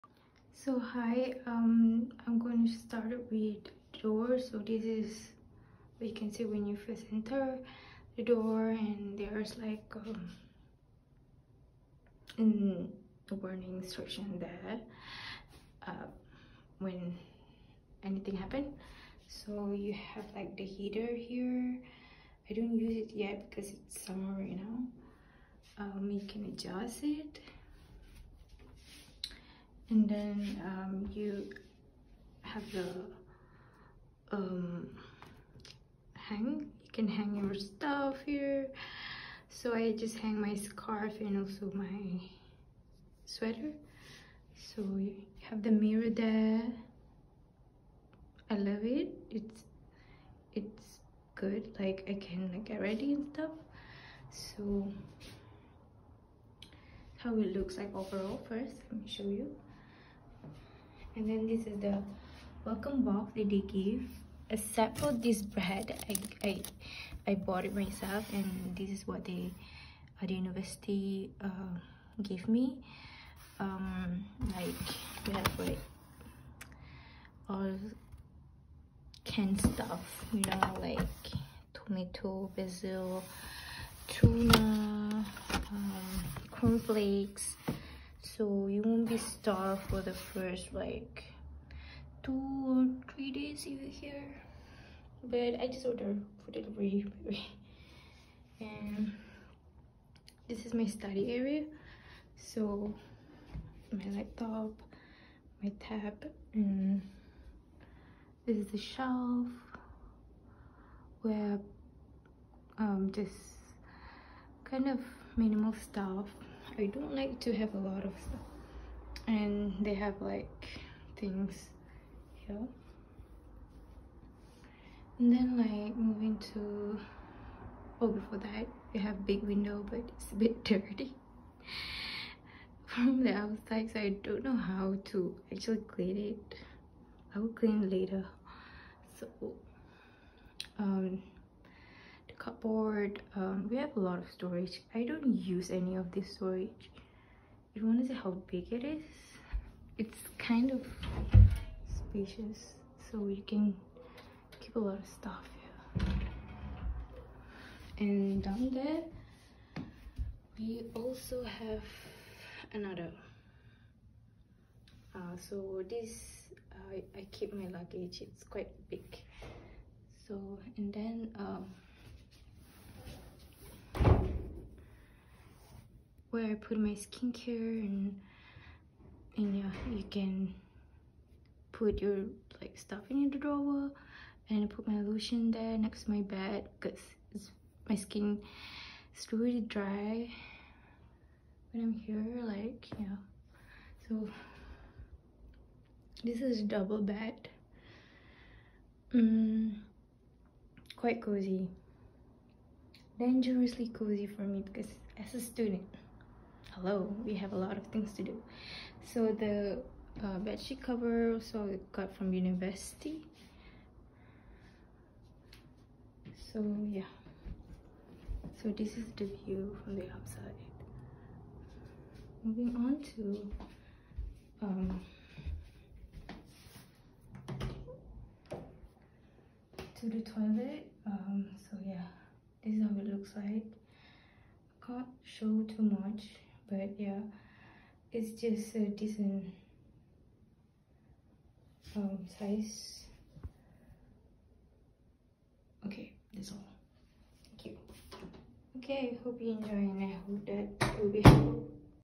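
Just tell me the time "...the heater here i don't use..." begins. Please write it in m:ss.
0:20.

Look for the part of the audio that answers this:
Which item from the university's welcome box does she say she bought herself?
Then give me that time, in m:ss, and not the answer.
1:05.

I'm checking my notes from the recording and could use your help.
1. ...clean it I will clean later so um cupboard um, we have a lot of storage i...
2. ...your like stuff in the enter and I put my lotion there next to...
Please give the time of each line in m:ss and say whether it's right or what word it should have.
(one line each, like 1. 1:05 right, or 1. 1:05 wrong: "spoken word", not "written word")
1. 2:15 right
2. 3:02 wrong: "drawer", not "enter".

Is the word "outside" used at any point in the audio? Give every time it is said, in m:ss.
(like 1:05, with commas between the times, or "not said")
2:13, 3:40.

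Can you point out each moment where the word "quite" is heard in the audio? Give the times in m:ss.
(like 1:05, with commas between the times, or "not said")
2:48, 3:20.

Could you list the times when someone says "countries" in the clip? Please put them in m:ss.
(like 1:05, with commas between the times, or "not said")
not said.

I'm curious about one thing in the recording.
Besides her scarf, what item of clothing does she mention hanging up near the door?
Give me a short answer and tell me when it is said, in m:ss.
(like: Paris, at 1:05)
sweater, at 0:43.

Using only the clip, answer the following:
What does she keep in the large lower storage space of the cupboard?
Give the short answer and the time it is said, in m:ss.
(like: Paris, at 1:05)
luggage, at 2:47.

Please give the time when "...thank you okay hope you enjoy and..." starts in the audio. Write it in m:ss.
4:07.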